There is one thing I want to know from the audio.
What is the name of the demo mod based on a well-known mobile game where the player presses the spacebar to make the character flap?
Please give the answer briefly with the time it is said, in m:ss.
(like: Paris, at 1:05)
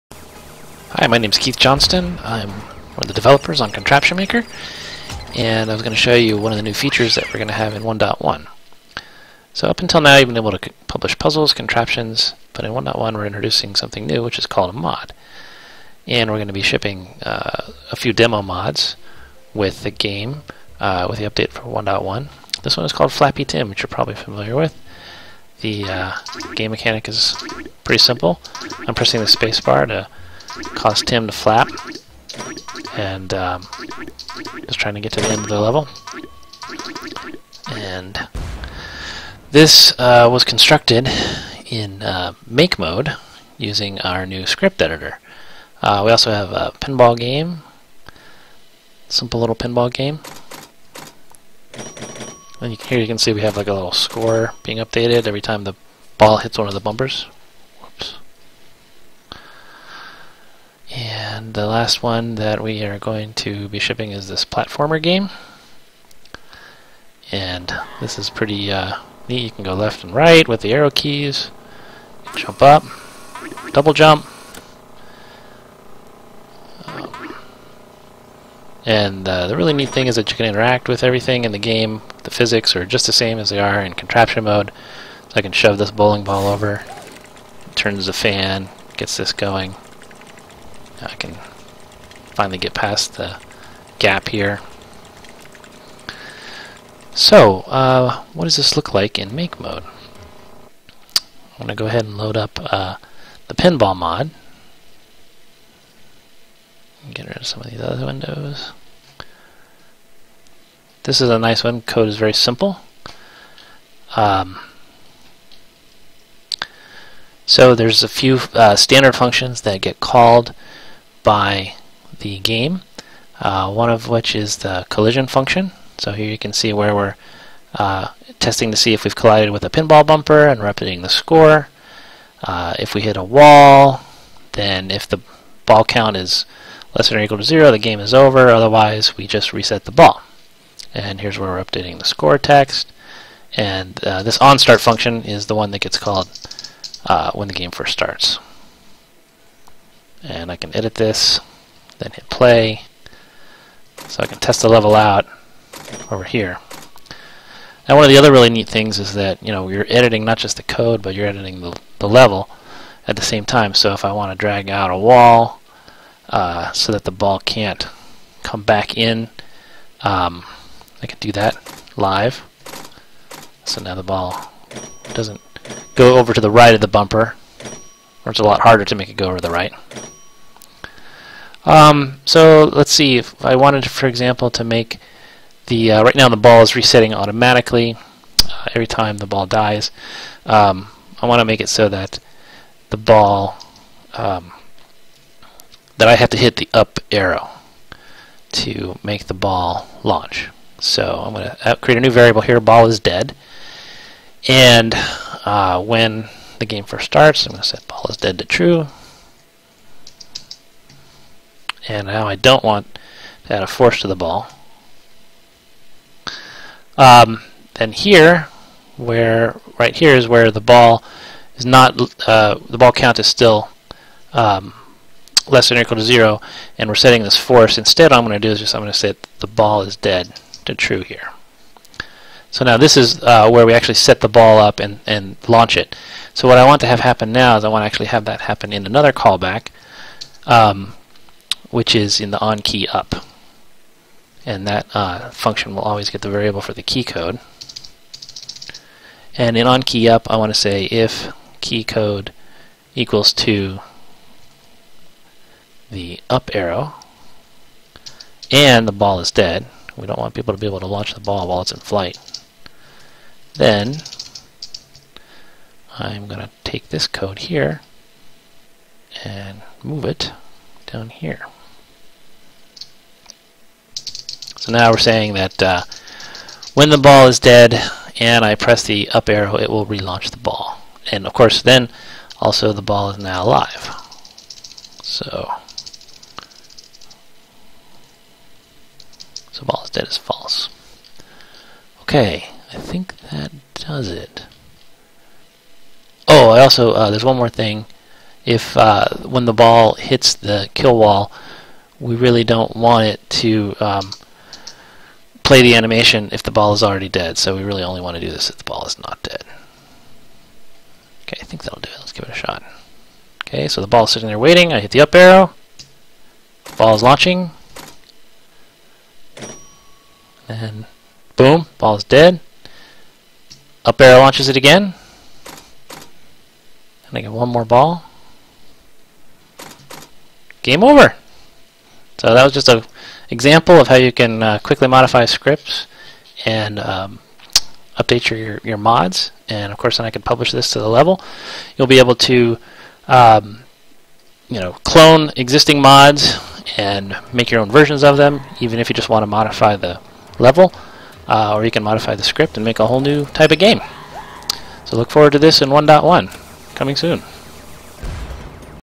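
Flappy Tim, at 0:23.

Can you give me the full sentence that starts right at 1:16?
Um, and uh, the really neat thing is that you can interact with everything in the game.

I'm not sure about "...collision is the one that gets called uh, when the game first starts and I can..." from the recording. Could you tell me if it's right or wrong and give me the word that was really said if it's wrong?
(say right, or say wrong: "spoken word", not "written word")
wrong: "function", not "collision".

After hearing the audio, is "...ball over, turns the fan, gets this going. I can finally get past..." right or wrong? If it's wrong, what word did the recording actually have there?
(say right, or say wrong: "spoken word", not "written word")
right.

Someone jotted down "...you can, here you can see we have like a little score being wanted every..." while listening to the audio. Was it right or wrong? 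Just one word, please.
wrong.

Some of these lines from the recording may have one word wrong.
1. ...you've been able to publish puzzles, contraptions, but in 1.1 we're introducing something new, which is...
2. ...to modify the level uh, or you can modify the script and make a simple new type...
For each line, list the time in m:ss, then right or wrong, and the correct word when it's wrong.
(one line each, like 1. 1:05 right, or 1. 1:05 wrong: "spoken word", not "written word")
1. 0:10 right
2. 5:49 wrong: "whole", not "simple".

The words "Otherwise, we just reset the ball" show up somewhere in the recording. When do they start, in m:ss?
2:18.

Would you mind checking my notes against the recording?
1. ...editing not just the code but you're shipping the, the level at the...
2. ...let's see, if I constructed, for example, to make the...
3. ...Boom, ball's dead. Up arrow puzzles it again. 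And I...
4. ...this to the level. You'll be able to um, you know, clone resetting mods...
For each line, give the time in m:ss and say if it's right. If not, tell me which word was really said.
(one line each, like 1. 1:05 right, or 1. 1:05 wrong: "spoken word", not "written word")
1. 2:39 wrong: "editing", not "shipping"
2. 3:02 wrong: "wanted", not "constructed"
3. 5:21 wrong: "launches", not "puzzles"
4. 5:40 wrong: "existing", not "resetting".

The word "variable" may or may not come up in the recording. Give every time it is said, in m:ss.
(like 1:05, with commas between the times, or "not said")
3:22, 4:06.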